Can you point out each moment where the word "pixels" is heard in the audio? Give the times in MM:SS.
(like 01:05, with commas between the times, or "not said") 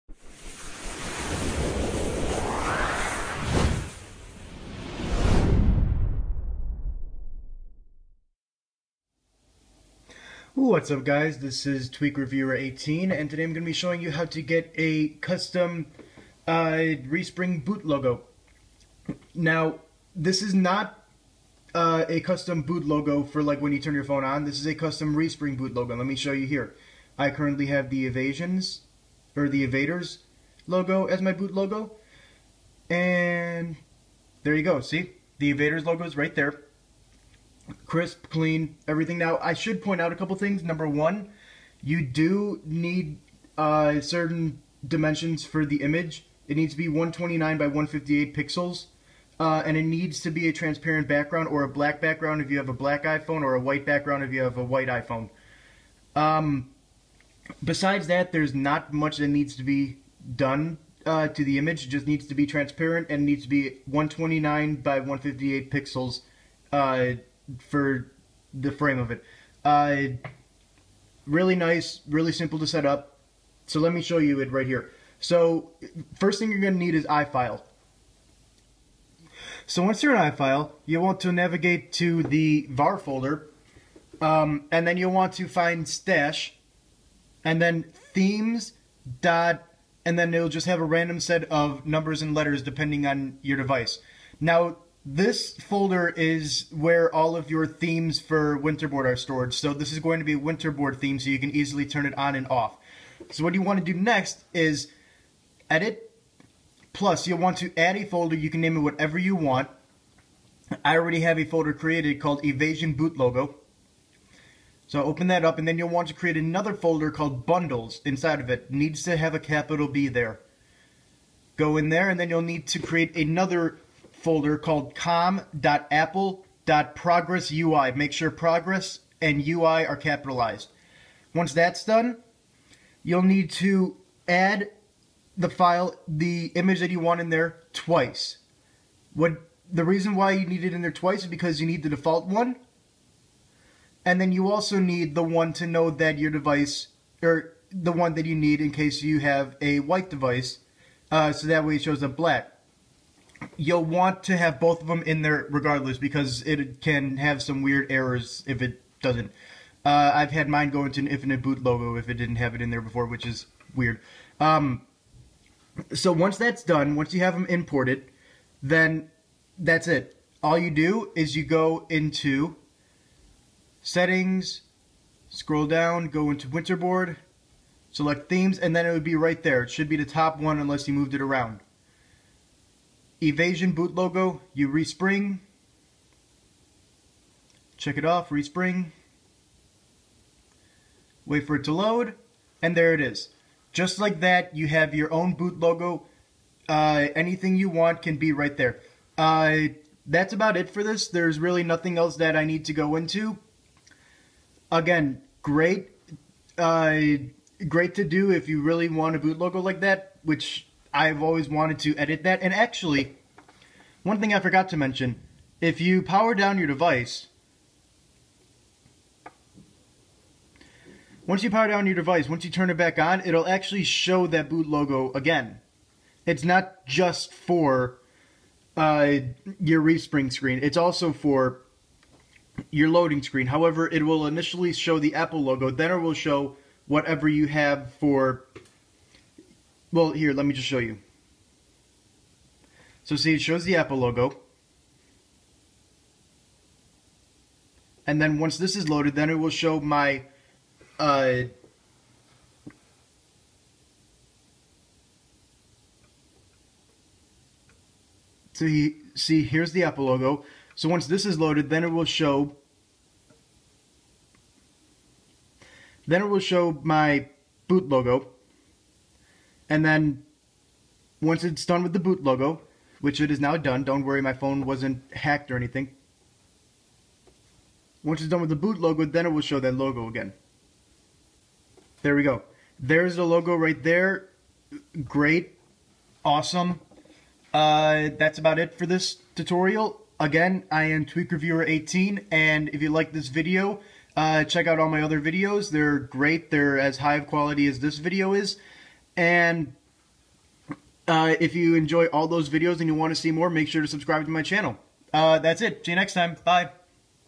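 00:48, 01:05.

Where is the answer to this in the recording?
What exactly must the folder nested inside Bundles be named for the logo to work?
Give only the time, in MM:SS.
02:04.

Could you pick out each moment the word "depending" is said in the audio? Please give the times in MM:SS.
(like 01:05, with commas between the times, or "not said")
01:32.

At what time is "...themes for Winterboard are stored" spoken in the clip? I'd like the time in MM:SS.
01:37.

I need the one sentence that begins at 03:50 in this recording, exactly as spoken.
It's also for your loading screen.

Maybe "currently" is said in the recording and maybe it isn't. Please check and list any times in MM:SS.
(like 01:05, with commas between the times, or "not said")
00:27.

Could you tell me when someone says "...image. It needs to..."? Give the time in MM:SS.
00:45.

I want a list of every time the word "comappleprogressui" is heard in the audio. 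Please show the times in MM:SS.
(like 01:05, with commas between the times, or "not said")
02:04.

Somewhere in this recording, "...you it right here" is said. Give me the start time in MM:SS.
01:14.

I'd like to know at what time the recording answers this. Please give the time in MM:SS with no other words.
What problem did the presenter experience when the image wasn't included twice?
02:41.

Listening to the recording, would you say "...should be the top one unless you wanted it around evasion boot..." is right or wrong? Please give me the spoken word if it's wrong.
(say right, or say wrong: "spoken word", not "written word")
wrong: "moved", not "wanted".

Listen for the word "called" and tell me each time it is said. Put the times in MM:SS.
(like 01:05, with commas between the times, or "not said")
01:52, 01:57, 02:04.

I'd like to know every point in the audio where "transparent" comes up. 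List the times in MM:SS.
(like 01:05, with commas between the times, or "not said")
00:50, 01:02.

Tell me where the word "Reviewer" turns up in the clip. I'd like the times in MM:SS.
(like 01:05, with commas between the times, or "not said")
00:12, 04:51.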